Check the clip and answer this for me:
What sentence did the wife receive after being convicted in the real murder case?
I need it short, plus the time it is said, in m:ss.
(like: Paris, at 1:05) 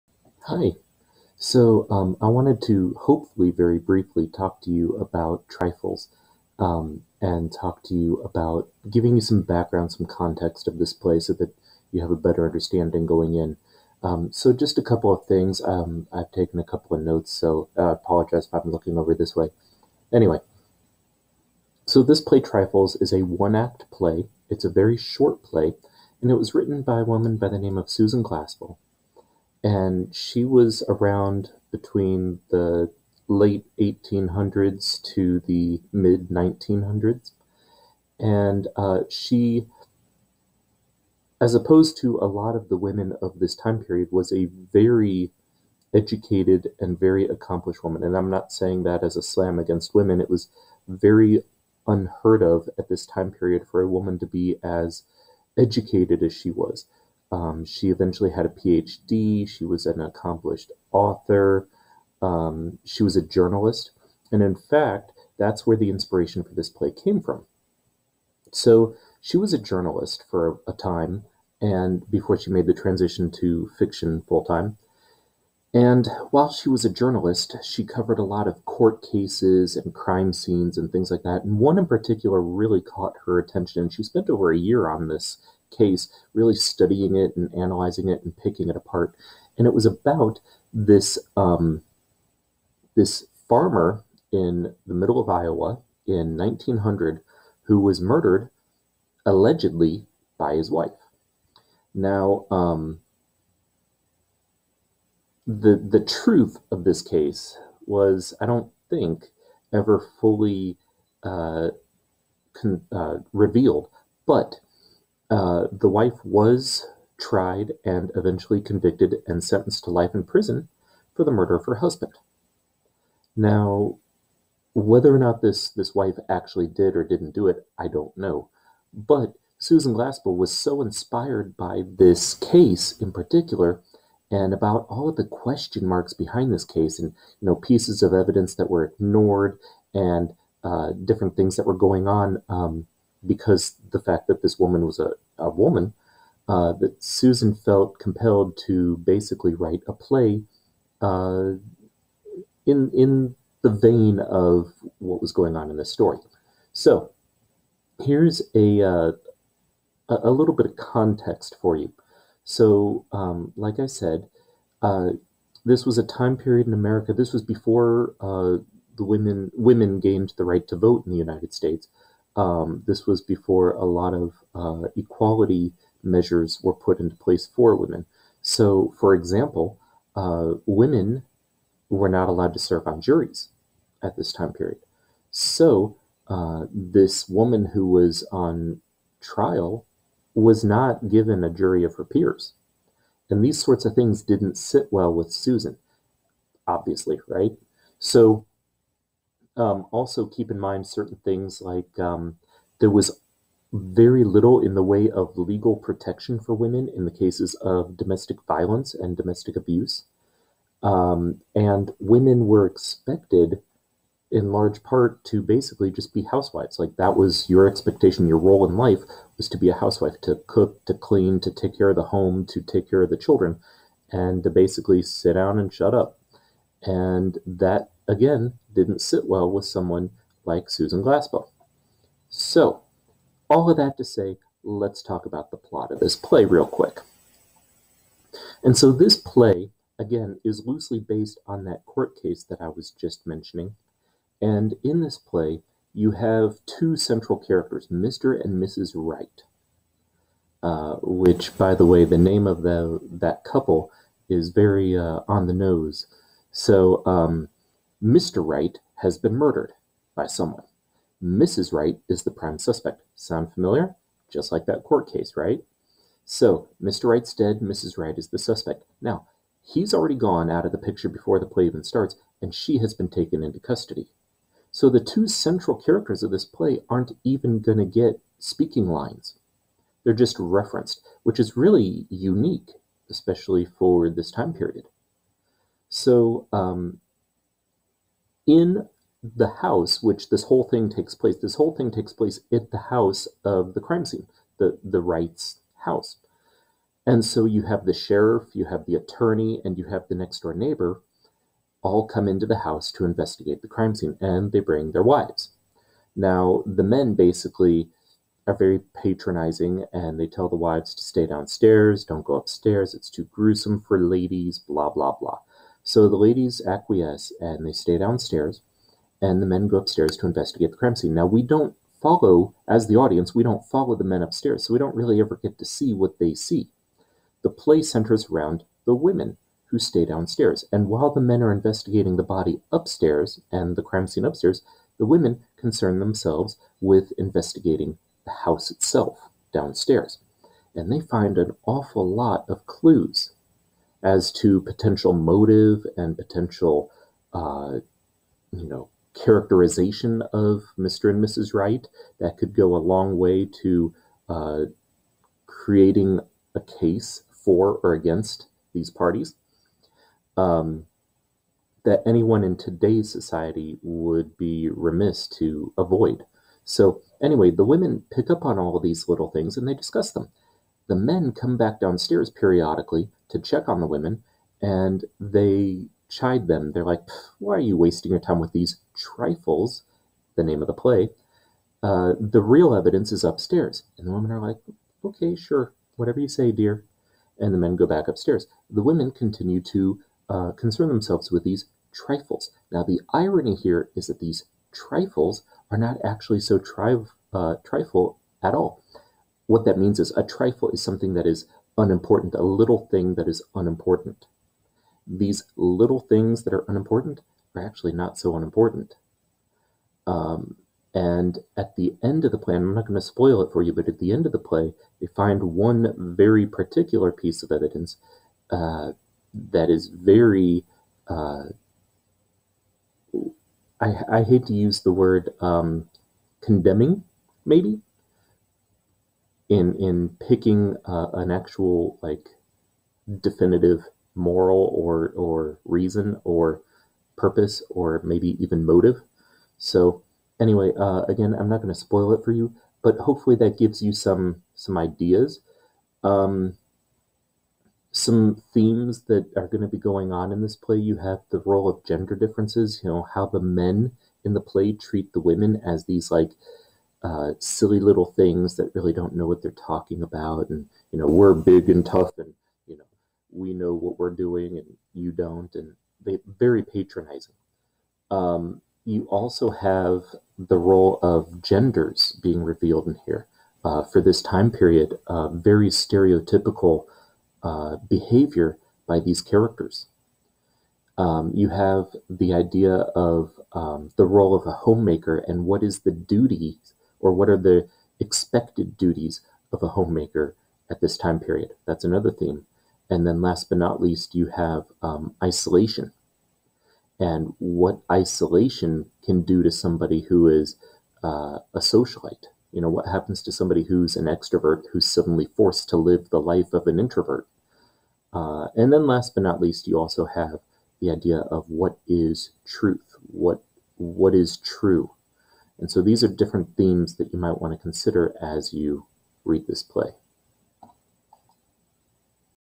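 life in prison, at 1:59.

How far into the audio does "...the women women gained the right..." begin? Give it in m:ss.
2:48.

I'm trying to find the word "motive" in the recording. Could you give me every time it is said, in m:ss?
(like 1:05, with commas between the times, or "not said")
5:45, 7:18.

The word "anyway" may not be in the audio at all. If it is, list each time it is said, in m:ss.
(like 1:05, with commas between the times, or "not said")
0:20, 6:07, 7:20.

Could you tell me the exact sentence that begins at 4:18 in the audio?
Wright has been murdered by someone.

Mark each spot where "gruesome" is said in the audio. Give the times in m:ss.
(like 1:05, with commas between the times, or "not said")
5:13.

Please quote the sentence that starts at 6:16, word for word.
They're like, why are you wasting your time with these trifles?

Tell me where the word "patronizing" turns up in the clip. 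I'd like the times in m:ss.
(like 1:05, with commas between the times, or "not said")
5:09, 7:46.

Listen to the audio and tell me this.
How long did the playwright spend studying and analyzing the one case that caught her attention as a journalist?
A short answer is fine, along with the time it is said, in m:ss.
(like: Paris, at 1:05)
over a year, at 1:24.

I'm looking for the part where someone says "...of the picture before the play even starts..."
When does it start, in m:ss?
4:30.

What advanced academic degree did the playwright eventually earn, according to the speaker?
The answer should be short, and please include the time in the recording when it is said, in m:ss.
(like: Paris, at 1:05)
PhD, at 0:58.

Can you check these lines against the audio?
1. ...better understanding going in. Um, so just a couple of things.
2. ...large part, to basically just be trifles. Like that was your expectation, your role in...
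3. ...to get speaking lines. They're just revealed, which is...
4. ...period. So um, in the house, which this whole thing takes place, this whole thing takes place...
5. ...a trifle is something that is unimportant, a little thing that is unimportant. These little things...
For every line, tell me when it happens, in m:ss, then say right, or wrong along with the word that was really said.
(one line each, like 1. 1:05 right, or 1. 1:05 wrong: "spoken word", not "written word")
1. 0:12 right
2. 3:34 wrong: "housewives", not "trifles"
3. 4:37 wrong: "referenced", not "revealed"
4. 4:44 right
5. 6:40 right.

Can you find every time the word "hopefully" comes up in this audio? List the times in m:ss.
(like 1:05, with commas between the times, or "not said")
0:02, 7:22.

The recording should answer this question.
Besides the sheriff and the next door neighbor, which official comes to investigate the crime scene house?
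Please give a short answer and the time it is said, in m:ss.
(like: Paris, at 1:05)
the attorney, at 4:58.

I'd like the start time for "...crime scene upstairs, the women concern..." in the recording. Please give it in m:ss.
5:33.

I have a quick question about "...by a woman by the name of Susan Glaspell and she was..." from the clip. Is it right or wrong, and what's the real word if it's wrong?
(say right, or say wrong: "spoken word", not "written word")
right.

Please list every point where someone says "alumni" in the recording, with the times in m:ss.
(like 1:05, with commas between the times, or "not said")
not said.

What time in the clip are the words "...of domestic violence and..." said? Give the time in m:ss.
3:27.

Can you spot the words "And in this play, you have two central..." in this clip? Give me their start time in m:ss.
4:04.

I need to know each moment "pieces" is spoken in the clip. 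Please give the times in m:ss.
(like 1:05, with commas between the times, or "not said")
2:17, 6:57.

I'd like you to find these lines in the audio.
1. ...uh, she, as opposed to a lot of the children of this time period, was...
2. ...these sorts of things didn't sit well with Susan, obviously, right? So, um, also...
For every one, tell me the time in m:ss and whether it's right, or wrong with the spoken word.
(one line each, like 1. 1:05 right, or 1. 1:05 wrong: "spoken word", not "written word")
1. 0:38 wrong: "women", not "children"
2. 3:13 right.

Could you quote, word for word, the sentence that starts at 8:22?
You know, what happens to somebody who's an extrovert who's suddenly forced to live the life of an introvert?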